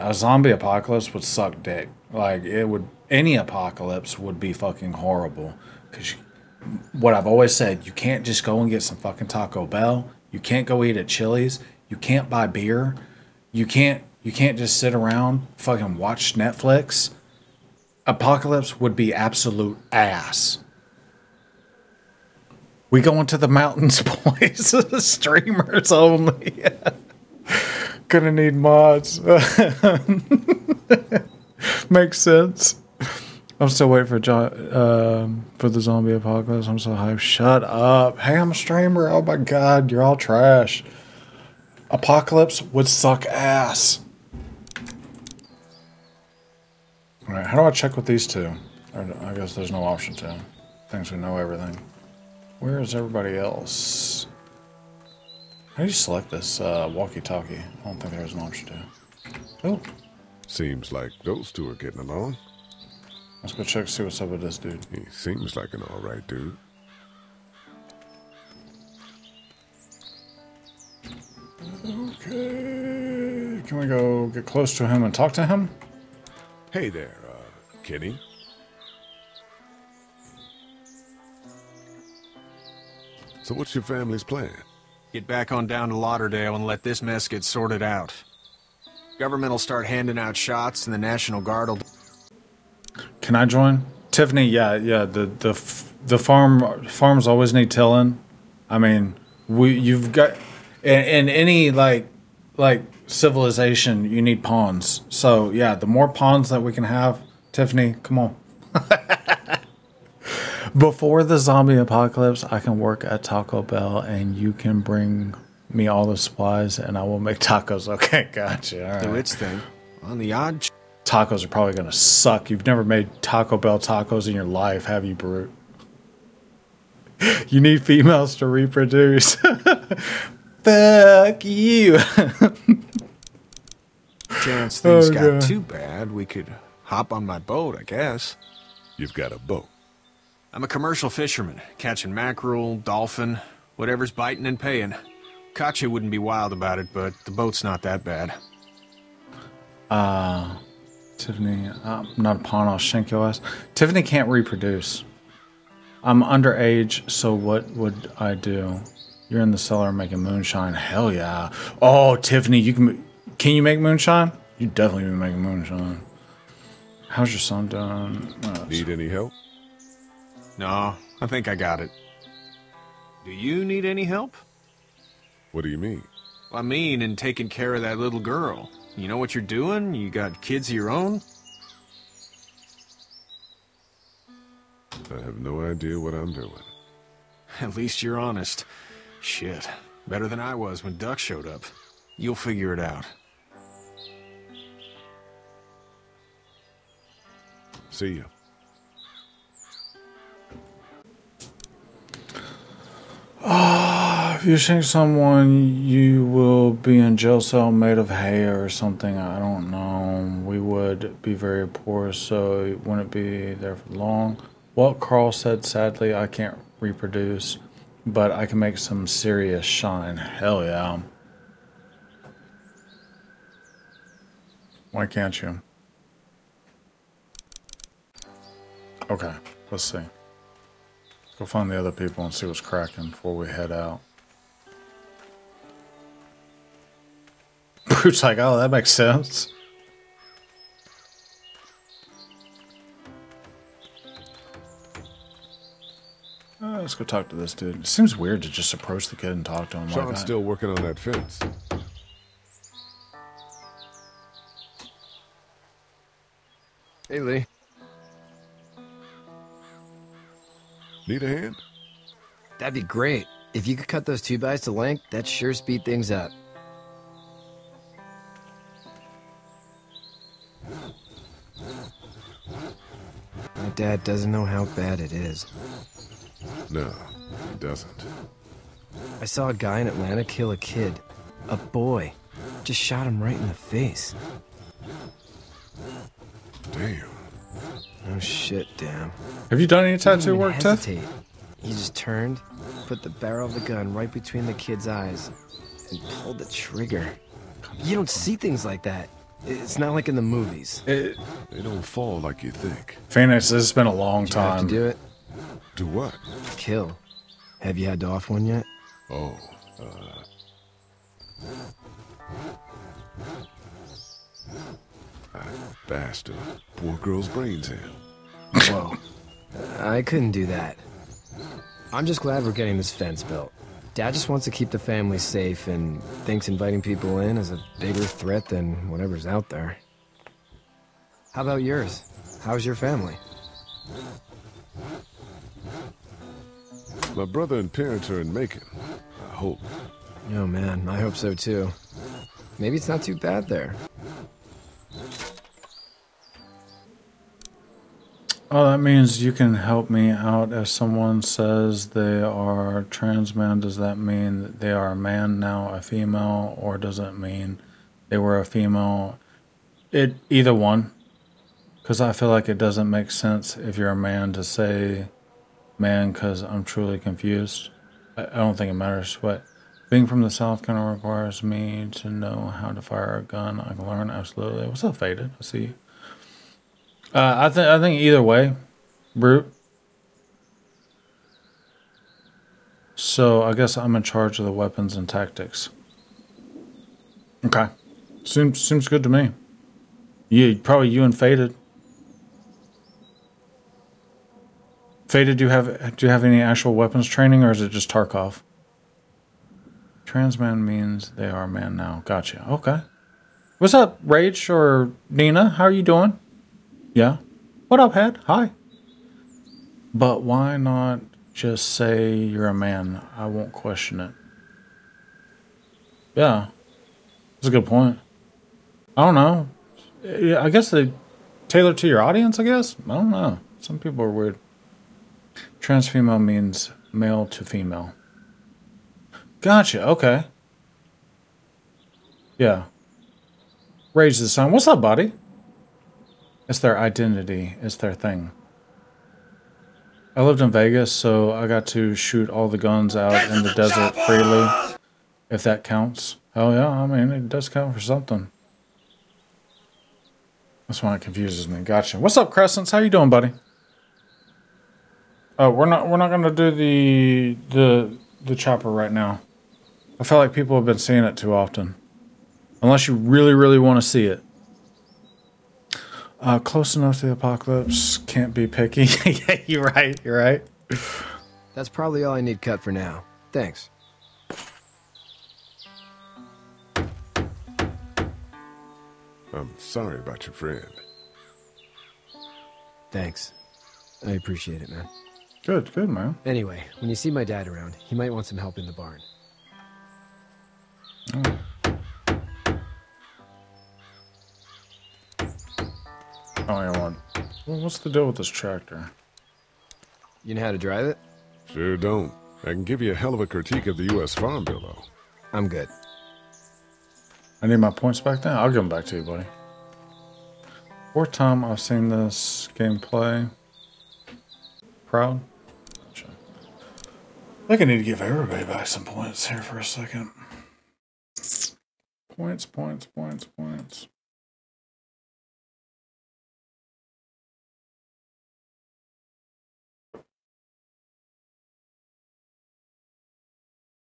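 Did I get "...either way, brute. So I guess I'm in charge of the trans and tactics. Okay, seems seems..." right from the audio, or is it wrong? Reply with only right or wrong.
wrong.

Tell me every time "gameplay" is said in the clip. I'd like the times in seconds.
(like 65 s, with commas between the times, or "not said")
512 s.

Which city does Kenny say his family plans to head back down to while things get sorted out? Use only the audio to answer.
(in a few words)
Lauderdale.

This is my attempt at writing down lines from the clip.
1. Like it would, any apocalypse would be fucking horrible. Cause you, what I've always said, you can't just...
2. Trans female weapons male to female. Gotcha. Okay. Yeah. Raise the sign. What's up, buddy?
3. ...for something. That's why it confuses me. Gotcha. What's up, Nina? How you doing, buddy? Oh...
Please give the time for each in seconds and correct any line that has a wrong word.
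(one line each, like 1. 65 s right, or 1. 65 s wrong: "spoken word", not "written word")
1. 2 s right
2. 425 s wrong: "means", not "weapons"
3. 447 s wrong: "Crescents", not "Nina".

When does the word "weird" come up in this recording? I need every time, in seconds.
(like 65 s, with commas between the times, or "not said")
248 s, 424 s.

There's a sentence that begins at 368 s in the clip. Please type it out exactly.
I, I don't think it matters, but being from the South kind of requires me to know how to fire a gun.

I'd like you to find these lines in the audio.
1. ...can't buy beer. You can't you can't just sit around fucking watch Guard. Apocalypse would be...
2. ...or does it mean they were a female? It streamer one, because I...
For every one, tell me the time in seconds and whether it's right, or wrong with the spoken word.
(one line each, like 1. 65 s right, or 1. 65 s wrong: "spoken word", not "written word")
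1. 11 s wrong: "Netflix", not "Guard"
2. 356 s wrong: "either", not "streamer".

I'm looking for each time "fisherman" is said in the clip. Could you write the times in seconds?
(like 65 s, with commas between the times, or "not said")
141 s.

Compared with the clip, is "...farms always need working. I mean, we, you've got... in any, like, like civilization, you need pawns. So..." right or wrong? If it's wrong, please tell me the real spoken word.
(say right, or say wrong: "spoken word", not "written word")
wrong: "tilling", not "working".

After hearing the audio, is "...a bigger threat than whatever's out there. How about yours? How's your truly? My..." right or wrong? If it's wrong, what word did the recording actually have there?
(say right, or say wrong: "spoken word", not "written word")
wrong: "family", not "truly".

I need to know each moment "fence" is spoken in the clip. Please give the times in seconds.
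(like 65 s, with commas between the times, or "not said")
250 s, 322 s.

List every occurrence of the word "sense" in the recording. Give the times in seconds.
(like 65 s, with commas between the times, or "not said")
32 s, 238 s, 363 s.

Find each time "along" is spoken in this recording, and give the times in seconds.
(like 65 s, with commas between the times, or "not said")
62 s.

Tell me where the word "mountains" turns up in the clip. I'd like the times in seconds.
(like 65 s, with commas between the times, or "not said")
23 s.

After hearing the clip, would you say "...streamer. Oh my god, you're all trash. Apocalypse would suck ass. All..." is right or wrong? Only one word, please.
right.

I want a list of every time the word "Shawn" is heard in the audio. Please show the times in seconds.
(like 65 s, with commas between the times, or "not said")
249 s.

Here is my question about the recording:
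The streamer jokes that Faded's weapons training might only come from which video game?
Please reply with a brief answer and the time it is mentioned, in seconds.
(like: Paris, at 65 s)
Tarkov, at 397 s.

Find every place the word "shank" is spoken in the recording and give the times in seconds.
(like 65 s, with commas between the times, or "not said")
152 s, 204 s.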